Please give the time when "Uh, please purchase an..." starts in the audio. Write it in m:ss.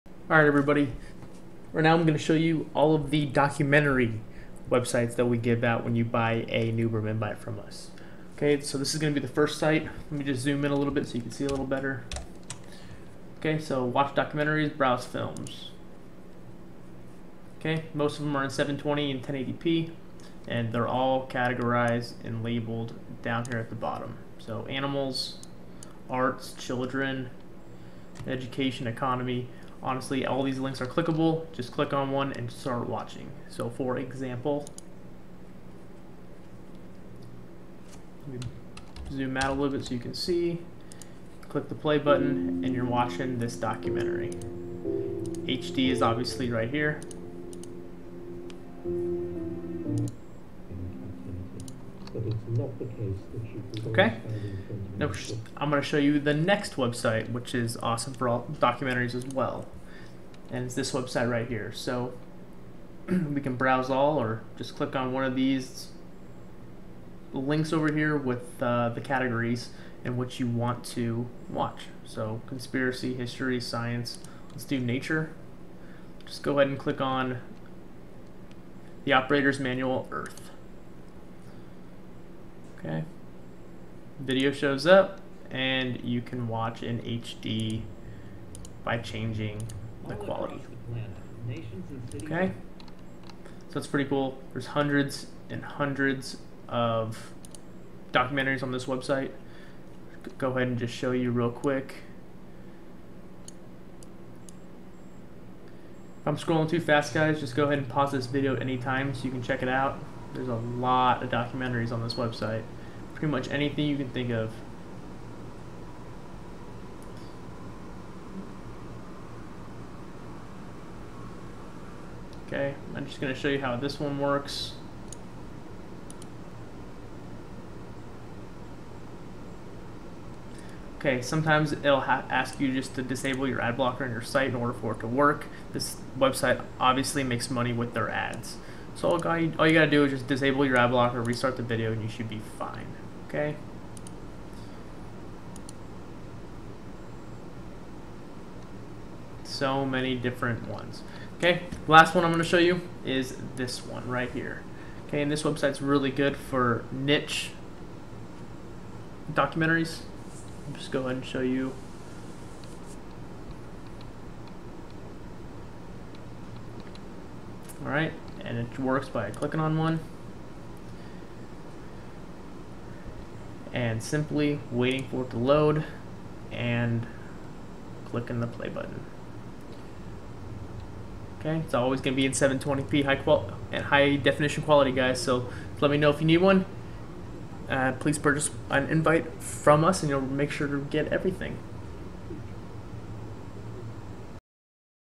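3:07.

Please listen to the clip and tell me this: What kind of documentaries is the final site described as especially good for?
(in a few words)
Niche documentaries.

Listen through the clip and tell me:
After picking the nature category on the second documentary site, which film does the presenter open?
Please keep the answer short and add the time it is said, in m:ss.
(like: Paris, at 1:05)
The Operator's Manual Earth, at 1:19.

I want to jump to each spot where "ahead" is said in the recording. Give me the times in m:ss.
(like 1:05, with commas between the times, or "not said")
1:16, 1:40, 1:47, 2:41.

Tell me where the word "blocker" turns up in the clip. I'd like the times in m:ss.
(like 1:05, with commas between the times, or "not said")
2:13, 2:20.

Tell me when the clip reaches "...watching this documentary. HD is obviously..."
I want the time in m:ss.
0:42.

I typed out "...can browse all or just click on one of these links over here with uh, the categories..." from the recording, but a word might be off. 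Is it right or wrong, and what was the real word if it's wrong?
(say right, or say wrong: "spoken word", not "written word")
right.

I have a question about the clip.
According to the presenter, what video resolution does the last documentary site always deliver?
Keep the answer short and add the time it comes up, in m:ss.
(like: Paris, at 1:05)
720p, at 3:02.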